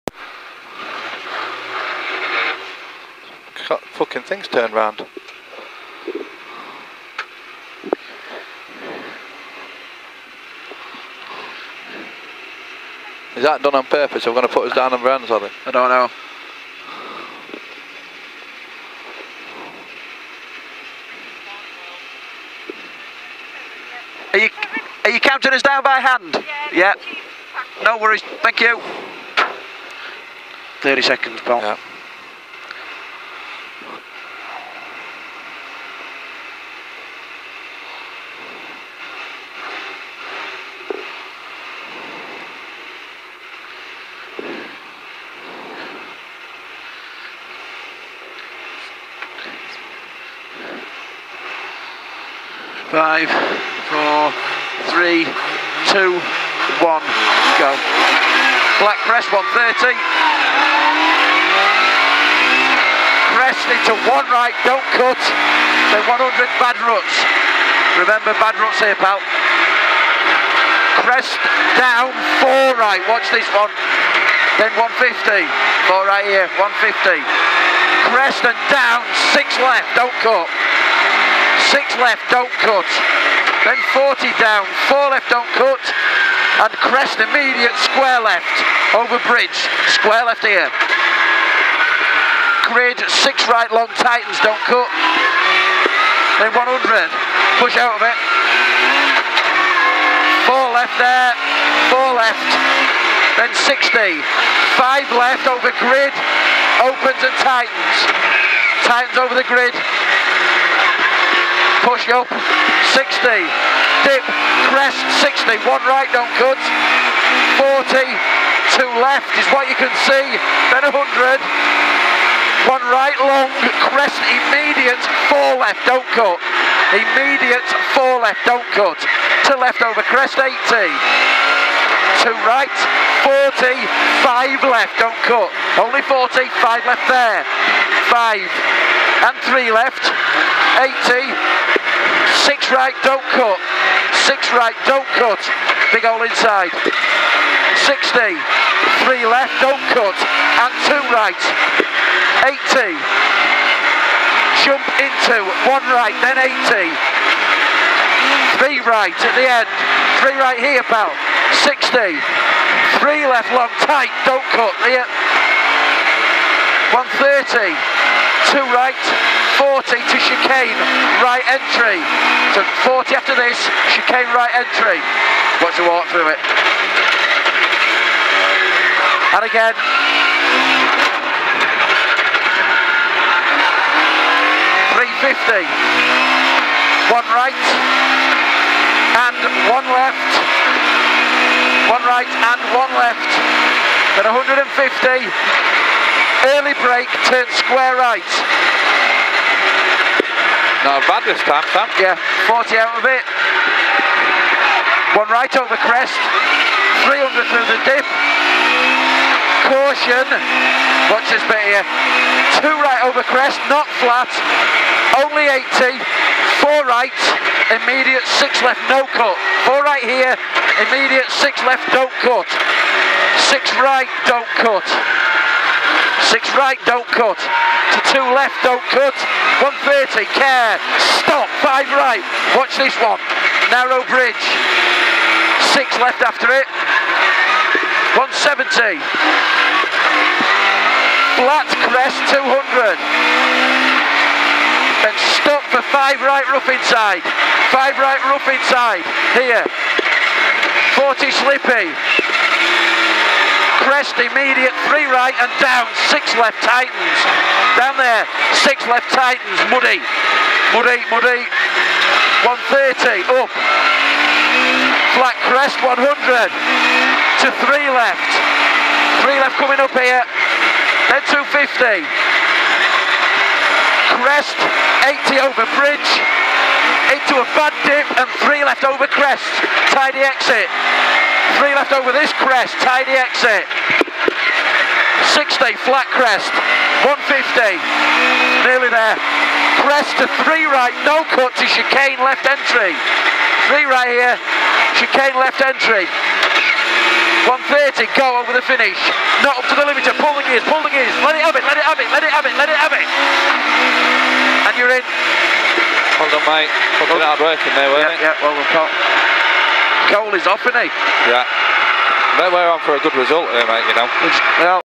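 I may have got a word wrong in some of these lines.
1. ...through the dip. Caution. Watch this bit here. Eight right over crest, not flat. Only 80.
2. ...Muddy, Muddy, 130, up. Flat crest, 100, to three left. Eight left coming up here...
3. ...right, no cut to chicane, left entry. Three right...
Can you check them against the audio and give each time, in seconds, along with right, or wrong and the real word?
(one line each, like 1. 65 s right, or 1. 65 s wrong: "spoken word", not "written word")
1. 207 s wrong: "Two", not "Eight"
2. 260 s wrong: "Three", not "Eight"
3. 290 s right.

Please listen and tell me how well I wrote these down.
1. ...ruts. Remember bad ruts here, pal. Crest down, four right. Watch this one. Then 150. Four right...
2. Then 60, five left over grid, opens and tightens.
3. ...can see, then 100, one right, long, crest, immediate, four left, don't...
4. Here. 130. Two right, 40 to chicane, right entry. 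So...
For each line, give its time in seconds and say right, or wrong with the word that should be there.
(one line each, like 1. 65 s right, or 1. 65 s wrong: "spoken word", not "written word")
1. 66 s right
2. 103 s right
3. 119 s right
4. 164 s right.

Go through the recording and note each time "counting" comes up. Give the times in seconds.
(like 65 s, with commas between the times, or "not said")
25 s.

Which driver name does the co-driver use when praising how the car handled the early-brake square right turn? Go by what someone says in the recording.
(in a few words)
Sam.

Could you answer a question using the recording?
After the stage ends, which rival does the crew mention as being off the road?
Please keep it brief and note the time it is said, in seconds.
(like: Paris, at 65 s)
Cole, at 310 s.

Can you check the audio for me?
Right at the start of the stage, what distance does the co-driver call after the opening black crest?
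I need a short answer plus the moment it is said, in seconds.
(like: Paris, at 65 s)
130, at 58 s.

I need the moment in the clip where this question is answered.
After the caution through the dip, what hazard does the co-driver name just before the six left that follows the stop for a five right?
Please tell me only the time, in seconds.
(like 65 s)
233 s.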